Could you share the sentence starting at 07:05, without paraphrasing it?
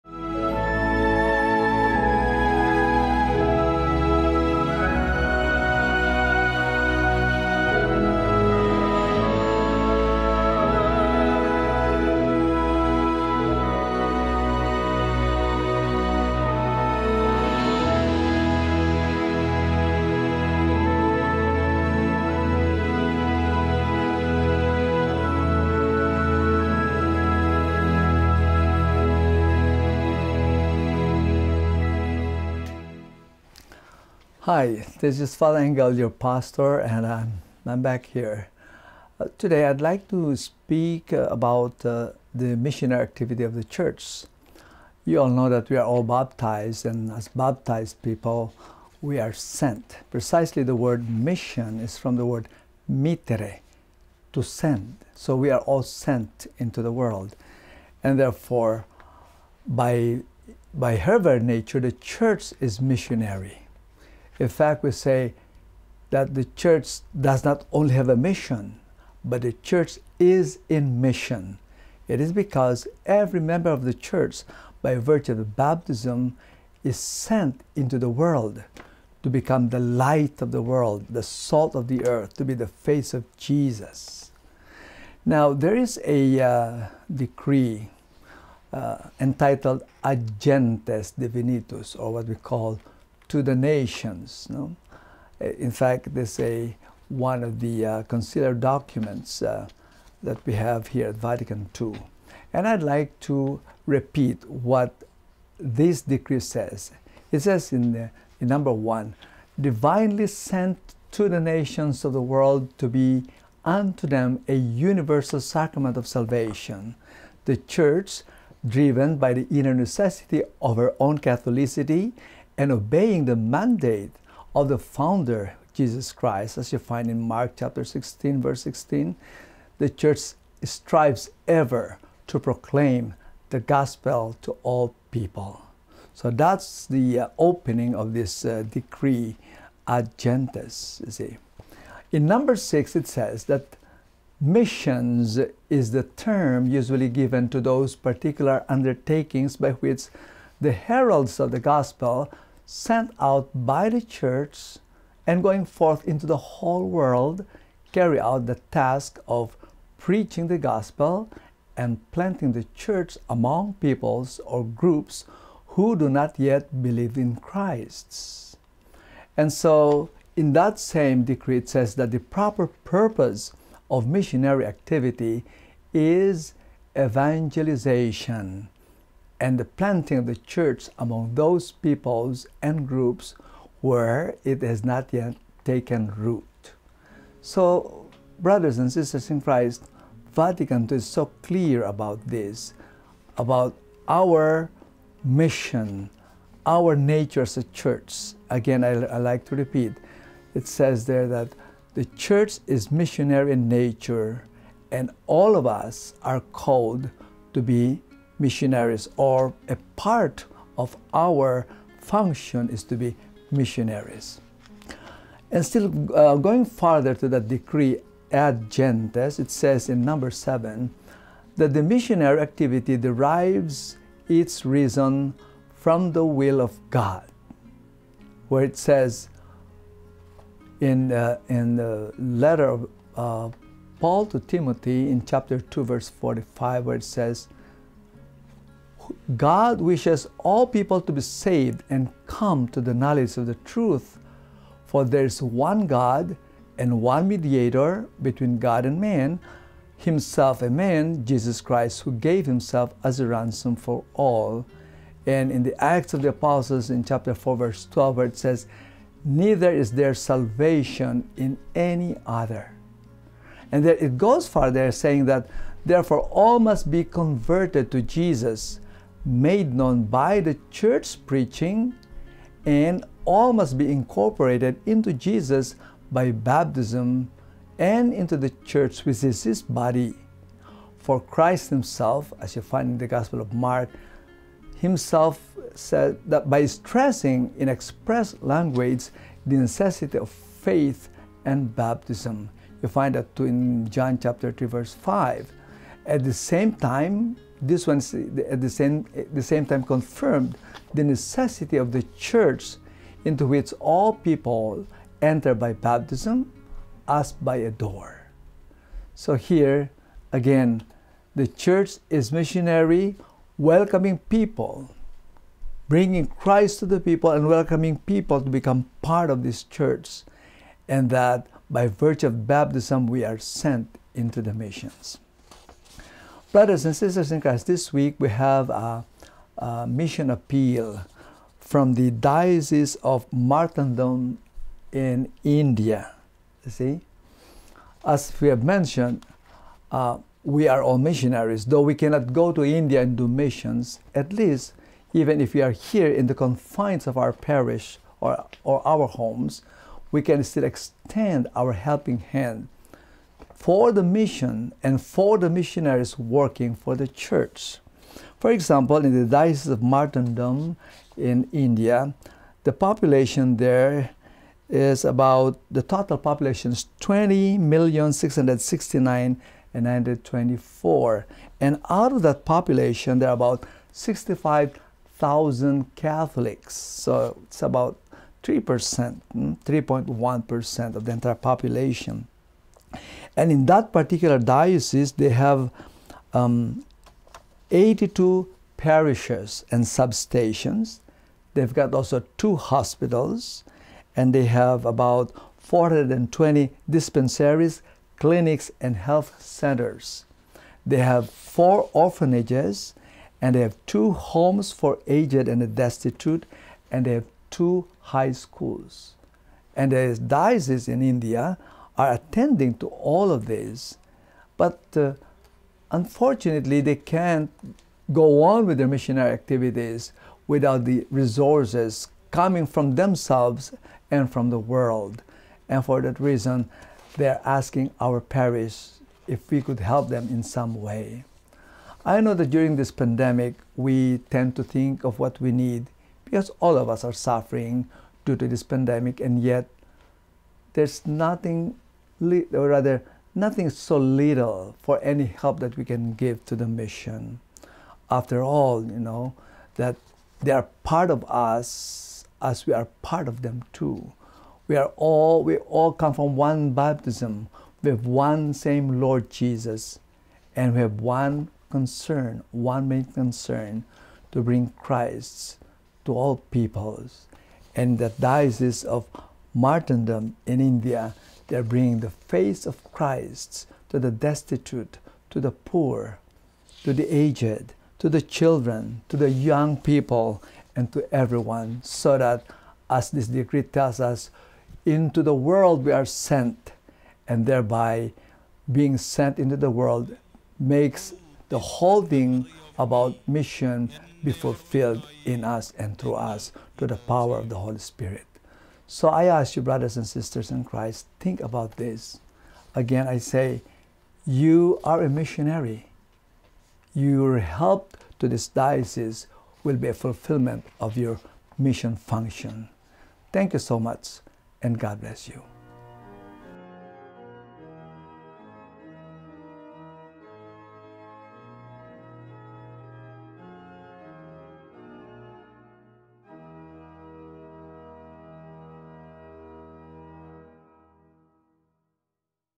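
And for that reason, they're asking our parish if we could help them in some way.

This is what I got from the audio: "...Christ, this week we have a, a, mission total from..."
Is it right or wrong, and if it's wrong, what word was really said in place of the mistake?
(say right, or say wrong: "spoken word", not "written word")
wrong: "appeal", not "total".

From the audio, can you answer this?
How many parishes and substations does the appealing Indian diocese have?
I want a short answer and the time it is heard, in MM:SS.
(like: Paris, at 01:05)
82, at 06:27.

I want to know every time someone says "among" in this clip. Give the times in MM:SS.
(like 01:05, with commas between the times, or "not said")
02:43, 03:00.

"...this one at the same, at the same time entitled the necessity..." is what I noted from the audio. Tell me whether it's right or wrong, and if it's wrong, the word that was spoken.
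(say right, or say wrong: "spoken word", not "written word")
wrong: "confirmed", not "entitled".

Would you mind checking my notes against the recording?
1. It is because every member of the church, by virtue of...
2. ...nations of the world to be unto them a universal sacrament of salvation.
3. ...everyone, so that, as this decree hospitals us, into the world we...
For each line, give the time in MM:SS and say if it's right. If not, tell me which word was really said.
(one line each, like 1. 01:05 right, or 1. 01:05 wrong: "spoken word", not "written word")
1. 01:12 right
2. 01:51 right
3. 08:01 wrong: "tells", not "hospitals".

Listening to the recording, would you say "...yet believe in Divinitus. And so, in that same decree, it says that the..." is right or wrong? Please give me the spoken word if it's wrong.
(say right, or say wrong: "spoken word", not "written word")
wrong: "Christ", not "Divinitus".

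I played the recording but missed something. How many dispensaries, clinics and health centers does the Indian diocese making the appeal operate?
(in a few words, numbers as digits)
420.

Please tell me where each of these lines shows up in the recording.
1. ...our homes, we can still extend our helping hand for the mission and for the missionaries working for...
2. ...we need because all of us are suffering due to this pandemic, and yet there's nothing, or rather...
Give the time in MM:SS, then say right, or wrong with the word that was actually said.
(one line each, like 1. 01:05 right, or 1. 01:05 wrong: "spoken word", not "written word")
1. 05:48 right
2. 07:15 right.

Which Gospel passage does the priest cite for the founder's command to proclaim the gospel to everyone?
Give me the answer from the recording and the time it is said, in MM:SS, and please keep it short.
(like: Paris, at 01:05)
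Mark 16:16, at 02:07.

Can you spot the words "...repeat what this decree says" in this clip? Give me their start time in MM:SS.
01:43.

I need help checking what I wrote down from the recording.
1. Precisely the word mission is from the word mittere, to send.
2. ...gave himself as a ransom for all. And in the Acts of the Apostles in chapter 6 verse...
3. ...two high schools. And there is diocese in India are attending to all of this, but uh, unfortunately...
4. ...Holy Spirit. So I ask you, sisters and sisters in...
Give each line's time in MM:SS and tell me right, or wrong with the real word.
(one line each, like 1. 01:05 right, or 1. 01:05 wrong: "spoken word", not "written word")
1. 00:50 right
2. 04:12 wrong: "4", not "6"
3. 06:47 right
4. 08:17 wrong: "brothers", not "sisters".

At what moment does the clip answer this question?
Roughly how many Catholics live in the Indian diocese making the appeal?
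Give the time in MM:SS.
06:13.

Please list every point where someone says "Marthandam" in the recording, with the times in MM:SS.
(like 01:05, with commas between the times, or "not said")
05:33, 05:59, 07:49.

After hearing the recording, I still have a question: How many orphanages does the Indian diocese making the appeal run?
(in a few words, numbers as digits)
4.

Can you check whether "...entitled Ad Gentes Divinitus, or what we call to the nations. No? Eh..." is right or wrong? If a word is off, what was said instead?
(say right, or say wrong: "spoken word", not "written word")
right.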